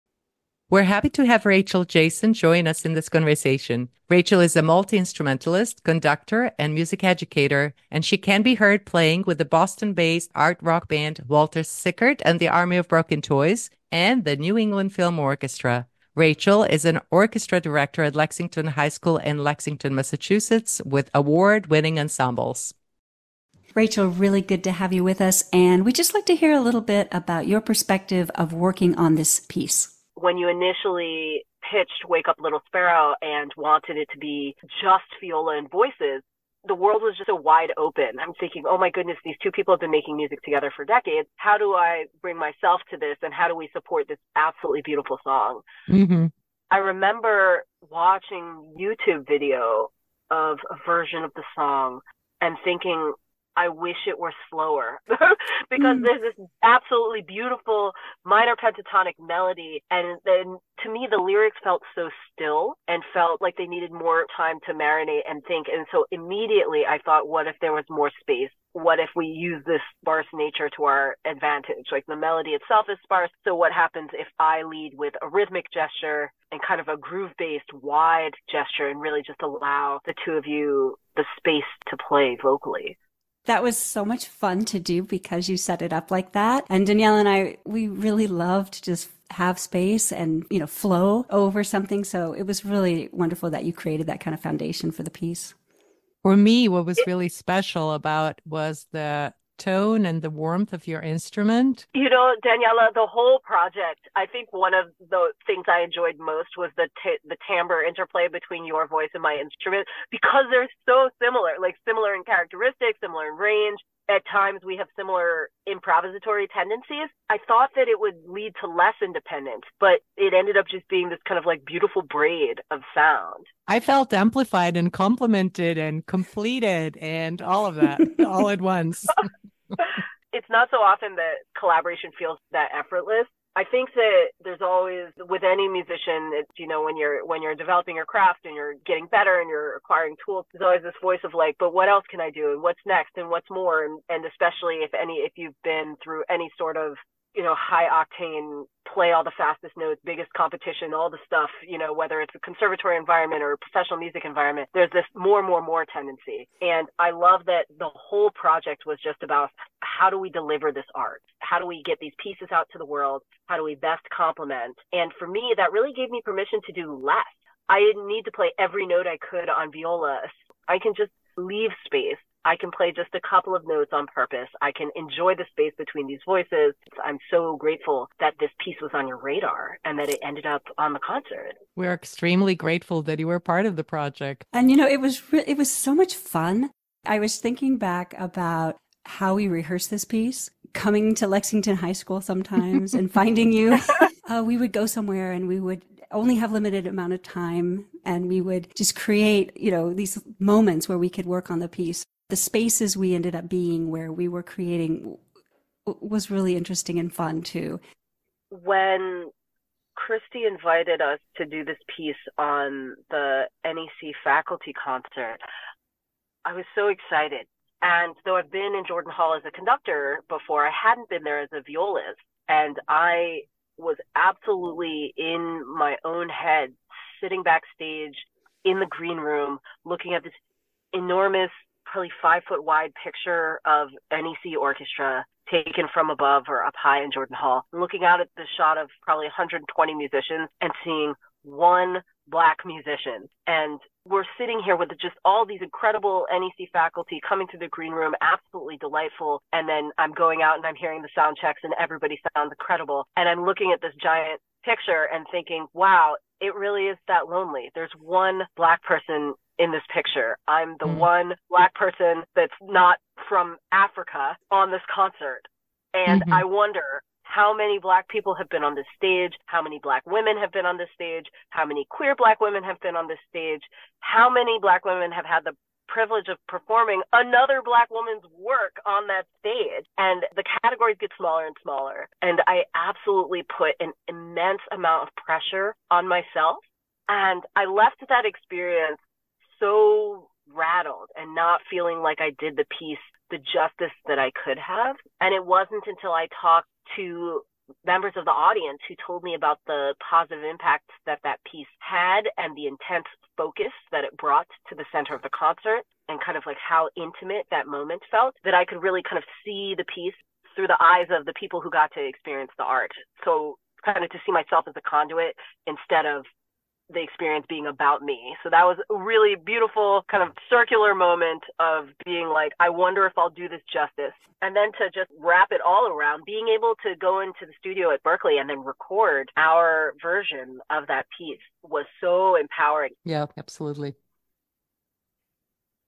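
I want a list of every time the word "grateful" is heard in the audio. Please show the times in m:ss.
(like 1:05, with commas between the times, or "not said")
2:57, 3:02.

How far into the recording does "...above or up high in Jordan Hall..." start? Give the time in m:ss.
3:56.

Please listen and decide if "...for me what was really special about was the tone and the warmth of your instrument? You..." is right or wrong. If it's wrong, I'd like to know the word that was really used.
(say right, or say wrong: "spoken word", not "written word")
right.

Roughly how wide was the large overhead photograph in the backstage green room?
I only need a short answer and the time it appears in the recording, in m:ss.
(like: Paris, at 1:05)
5 feet, at 3:52.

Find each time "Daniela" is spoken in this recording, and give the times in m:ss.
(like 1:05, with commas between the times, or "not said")
1:26, 1:42.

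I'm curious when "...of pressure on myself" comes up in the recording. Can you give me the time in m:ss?
4:45.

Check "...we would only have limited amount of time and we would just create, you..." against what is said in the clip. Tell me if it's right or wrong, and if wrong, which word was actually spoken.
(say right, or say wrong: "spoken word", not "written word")
right.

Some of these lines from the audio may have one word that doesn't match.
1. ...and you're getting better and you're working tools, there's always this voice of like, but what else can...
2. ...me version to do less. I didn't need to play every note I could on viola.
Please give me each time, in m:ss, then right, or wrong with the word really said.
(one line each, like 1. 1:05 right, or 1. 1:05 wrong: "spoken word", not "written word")
1. 2:18 wrong: "acquiring", not "working"
2. 2:46 wrong: "permission", not "version".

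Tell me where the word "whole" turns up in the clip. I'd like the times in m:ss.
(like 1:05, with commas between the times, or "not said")
1:43, 2:37.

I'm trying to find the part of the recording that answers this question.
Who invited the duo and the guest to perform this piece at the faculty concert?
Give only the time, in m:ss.
3:29.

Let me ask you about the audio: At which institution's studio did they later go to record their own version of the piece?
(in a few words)
Berklee.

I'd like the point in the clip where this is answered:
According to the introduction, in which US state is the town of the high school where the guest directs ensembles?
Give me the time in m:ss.
0:19.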